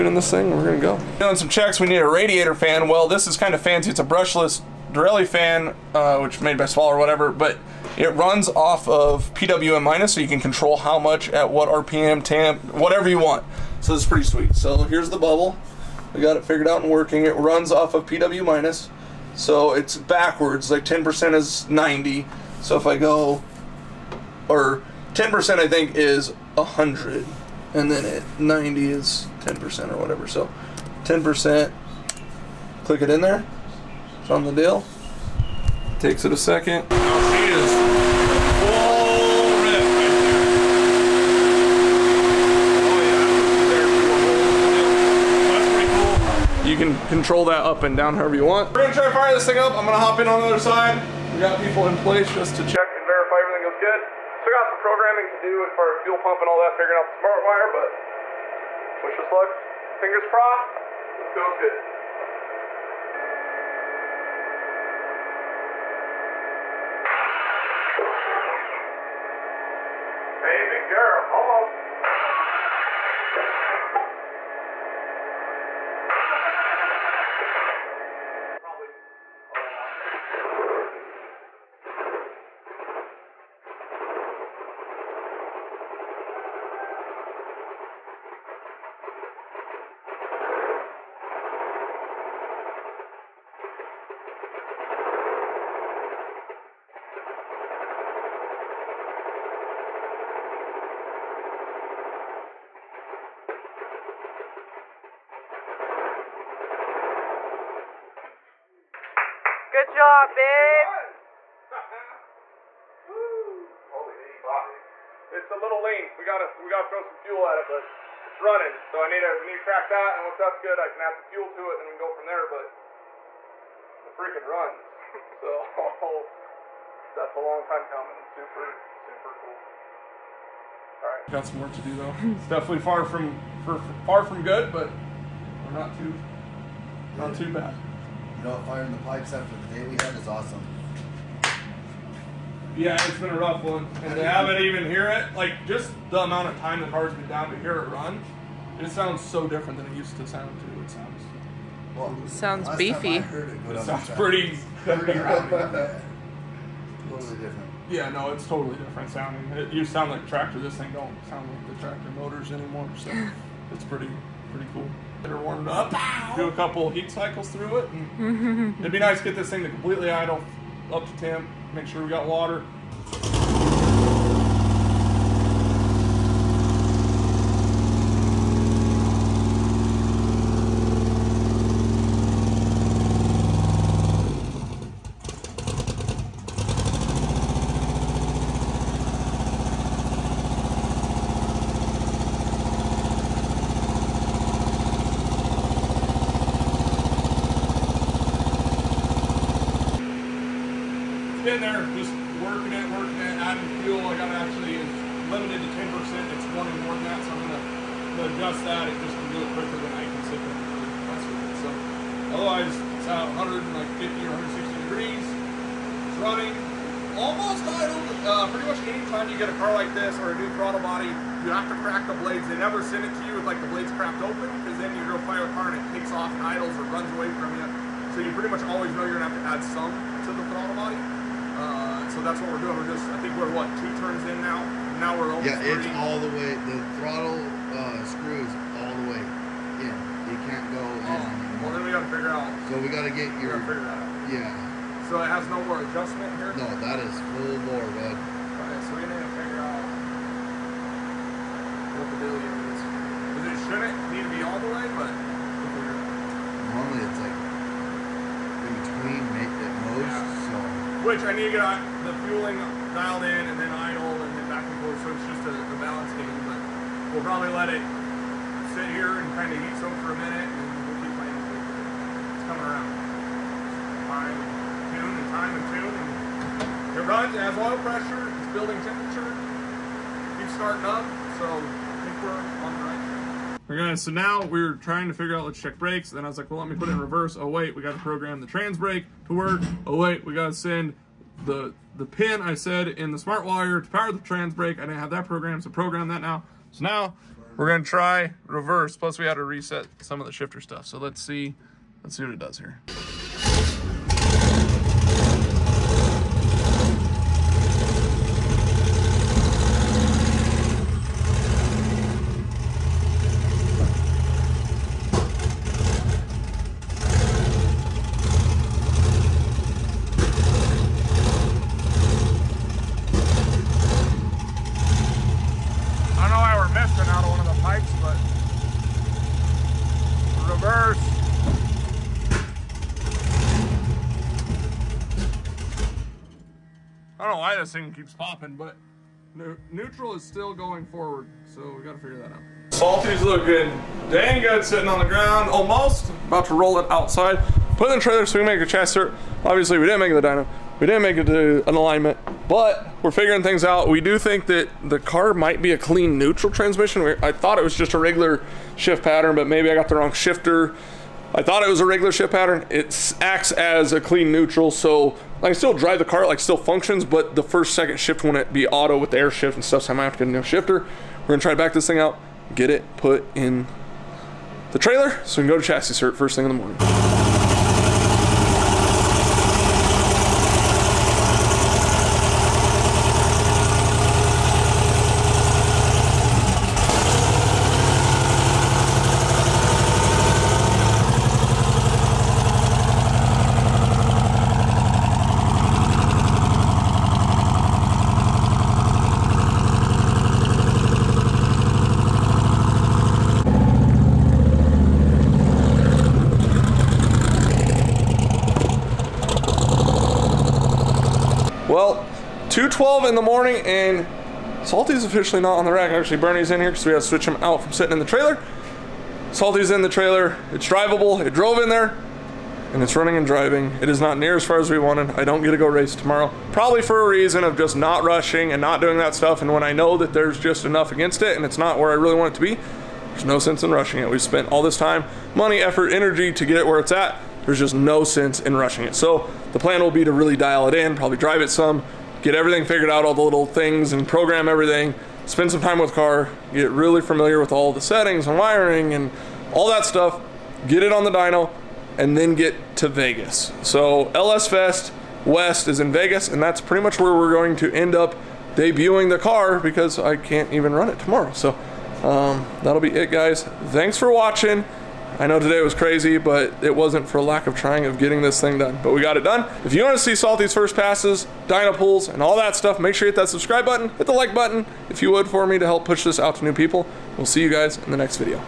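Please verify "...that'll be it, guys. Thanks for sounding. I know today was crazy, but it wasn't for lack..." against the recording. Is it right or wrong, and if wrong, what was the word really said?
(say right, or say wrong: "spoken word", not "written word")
wrong: "watching", not "sounding".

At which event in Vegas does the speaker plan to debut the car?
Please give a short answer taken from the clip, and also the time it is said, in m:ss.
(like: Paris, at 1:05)
LS Fest West, at 7:34.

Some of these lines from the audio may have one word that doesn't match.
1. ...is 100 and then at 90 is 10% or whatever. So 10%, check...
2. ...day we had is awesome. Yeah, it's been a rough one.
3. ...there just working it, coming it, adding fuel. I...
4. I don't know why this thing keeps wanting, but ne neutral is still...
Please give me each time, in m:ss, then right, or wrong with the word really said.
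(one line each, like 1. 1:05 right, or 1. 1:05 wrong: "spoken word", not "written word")
1. 0:25 wrong: "click", not "check"
2. 2:19 right
3. 3:21 wrong: "working", not "coming"
4. 5:37 wrong: "popping", not "wanting".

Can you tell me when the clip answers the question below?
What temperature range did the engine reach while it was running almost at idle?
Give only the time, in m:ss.
3:33.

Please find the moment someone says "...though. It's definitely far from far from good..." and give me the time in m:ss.
2:11.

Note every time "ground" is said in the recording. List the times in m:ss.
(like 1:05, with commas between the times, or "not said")
5:45.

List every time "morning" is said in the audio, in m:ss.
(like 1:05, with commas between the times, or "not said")
6:16, 6:53.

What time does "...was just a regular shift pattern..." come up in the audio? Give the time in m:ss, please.
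5:57.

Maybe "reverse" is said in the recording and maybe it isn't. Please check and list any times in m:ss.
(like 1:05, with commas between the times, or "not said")
4:46, 4:58, 5:30.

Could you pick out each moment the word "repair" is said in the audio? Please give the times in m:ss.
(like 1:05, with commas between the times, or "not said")
not said.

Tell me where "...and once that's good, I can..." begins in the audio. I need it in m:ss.
2:00.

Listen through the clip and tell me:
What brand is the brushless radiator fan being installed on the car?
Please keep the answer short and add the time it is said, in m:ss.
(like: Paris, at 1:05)
Derale, at 0:04.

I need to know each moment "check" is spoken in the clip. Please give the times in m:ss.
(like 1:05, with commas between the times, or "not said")
0:01, 0:52, 4:45.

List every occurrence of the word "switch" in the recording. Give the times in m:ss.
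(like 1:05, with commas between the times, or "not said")
6:57.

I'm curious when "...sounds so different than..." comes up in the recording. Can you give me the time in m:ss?
2:28.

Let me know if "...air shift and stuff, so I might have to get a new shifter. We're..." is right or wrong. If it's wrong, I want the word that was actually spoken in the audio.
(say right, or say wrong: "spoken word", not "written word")
right.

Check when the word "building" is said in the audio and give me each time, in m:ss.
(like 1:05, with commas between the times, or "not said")
4:38.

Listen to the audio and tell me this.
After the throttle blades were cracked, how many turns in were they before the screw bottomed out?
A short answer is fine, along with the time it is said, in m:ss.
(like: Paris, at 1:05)
2 turns, at 3:53.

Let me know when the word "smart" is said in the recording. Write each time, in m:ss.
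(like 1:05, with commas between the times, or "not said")
0:57, 4:53.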